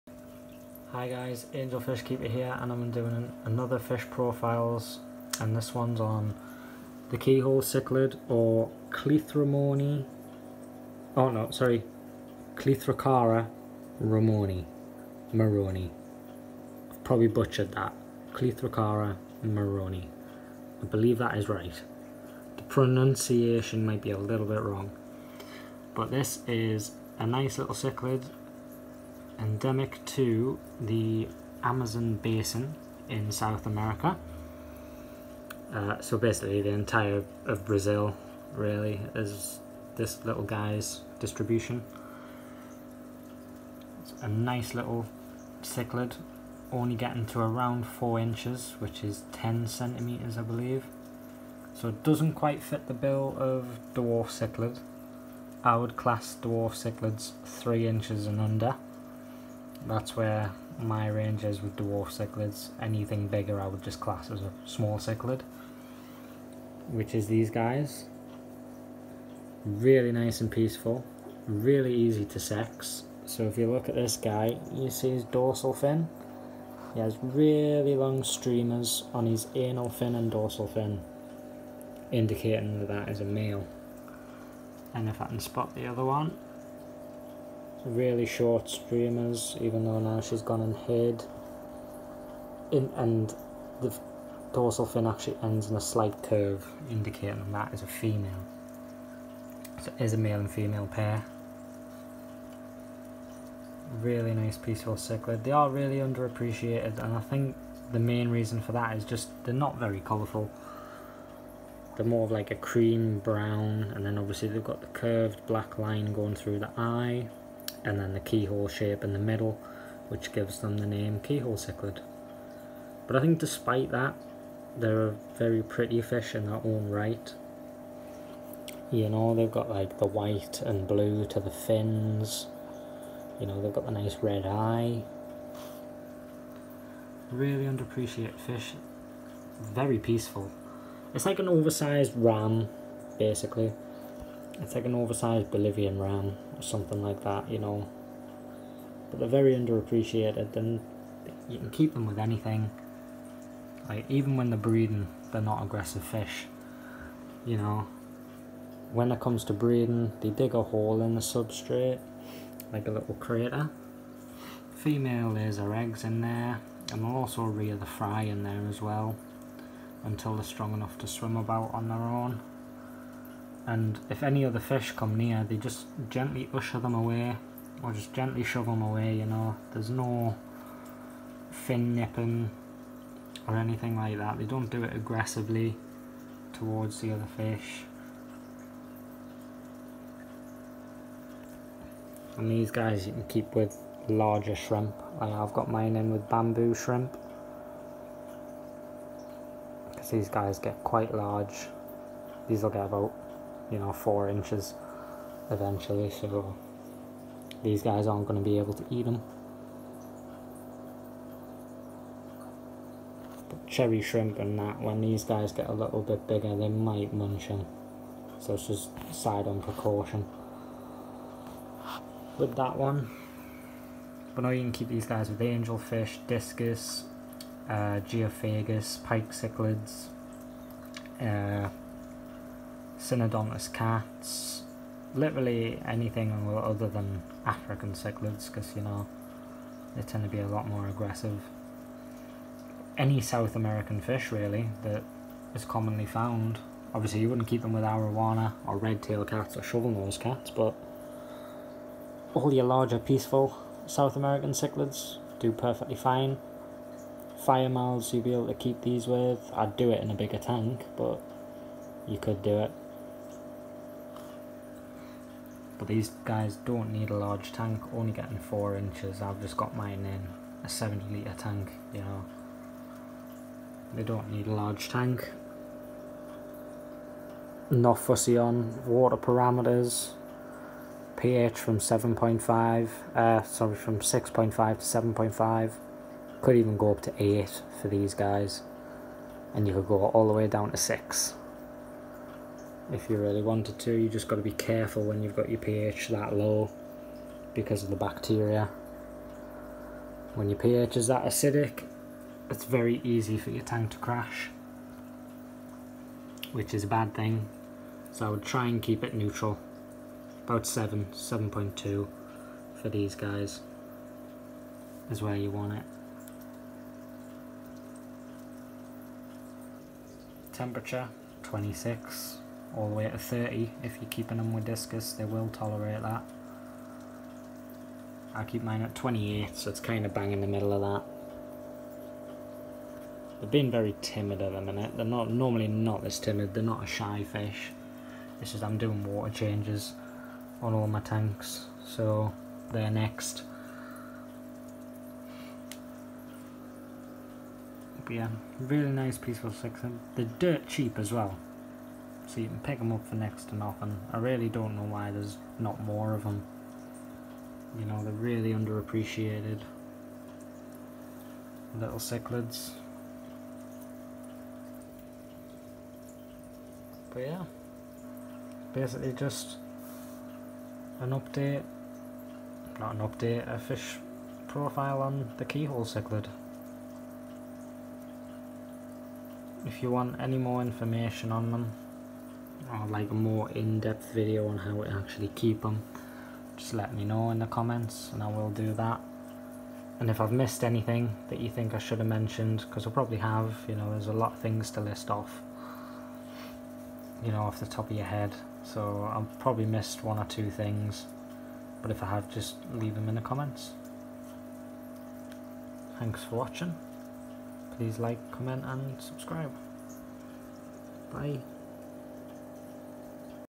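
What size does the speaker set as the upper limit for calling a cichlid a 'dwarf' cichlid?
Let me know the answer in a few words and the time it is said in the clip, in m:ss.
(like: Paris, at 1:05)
3 inches, at 0:57.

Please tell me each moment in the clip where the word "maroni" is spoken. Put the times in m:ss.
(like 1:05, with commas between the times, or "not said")
0:15, 0:19.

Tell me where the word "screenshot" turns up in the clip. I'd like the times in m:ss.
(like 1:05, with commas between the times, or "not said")
not said.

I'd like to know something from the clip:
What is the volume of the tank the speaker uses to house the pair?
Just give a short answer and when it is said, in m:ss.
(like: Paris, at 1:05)
70 litres, at 4:30.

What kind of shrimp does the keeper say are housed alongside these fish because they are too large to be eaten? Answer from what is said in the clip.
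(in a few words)
bamboo shrimp.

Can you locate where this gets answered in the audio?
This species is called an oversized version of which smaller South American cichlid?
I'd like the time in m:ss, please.
2:25.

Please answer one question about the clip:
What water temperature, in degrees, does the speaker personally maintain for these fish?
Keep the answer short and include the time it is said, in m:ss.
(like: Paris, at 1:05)
28, at 5:28.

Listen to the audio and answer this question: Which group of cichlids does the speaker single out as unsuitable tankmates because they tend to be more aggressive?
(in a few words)
African cichlids.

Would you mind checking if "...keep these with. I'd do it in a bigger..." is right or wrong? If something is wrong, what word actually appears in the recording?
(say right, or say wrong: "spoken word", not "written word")
right.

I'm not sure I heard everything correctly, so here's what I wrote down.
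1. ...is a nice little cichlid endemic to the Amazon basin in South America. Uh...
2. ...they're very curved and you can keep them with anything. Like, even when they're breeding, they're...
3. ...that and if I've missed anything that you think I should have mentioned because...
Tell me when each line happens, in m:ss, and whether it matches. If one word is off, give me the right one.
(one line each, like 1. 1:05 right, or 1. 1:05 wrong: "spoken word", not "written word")
1. 0:26 right
2. 2:29 wrong: "underappreciated", not "curved"
3. 6:28 right.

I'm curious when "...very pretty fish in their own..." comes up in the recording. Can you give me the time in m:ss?
2:05.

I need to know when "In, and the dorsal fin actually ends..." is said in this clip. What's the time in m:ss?
1:32.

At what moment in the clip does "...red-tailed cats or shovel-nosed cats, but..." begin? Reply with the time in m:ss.
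4:08.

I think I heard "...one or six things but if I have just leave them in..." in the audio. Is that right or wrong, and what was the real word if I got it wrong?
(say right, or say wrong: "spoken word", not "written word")
wrong: "two", not "six".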